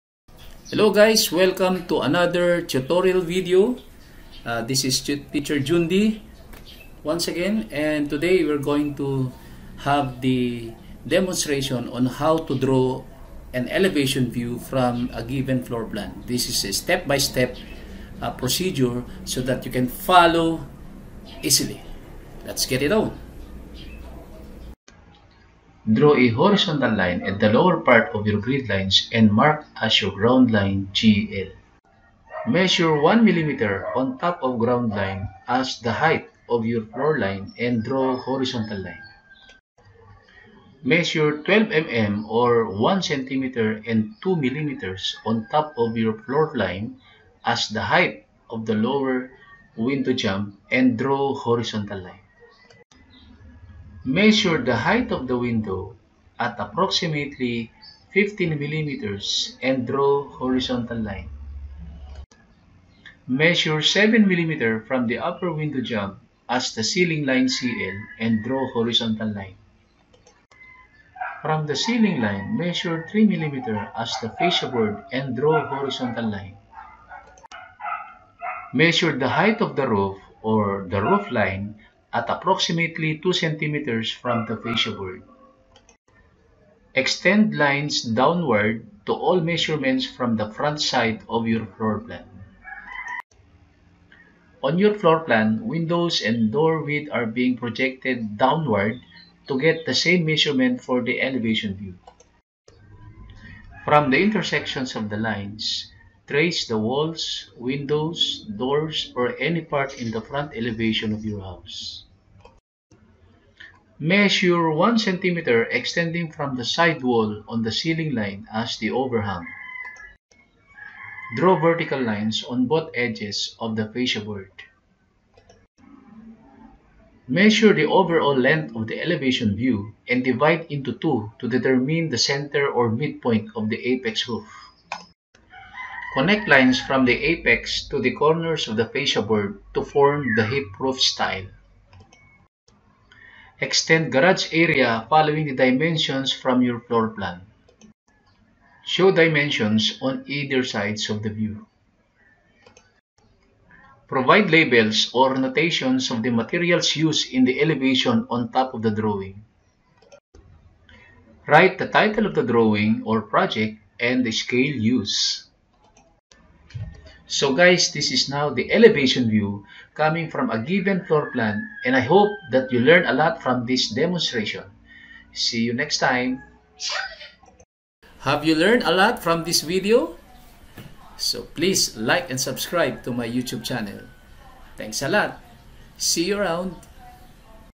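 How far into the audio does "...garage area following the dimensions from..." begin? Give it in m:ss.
2:24.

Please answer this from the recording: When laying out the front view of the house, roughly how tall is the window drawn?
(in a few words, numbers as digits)
15 millimeters.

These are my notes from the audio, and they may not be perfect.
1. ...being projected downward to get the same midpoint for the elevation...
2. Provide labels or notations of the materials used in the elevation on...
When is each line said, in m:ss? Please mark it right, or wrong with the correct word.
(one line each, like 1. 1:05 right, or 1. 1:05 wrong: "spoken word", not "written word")
1. 1:37 wrong: "measurement", not "midpoint"
2. 2:34 right.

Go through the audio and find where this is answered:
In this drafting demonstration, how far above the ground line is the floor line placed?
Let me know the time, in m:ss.
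0:33.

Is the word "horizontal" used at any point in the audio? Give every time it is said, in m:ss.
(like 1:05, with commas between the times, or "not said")
0:26, 0:38, 0:51, 1:00, 1:08, 1:15.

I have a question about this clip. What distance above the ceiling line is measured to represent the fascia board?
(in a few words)
3 millimeters.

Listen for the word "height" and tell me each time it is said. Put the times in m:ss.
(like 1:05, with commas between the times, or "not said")
0:35, 0:47, 0:54, 1:19.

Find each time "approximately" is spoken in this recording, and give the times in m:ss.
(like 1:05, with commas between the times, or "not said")
0:56, 1:22.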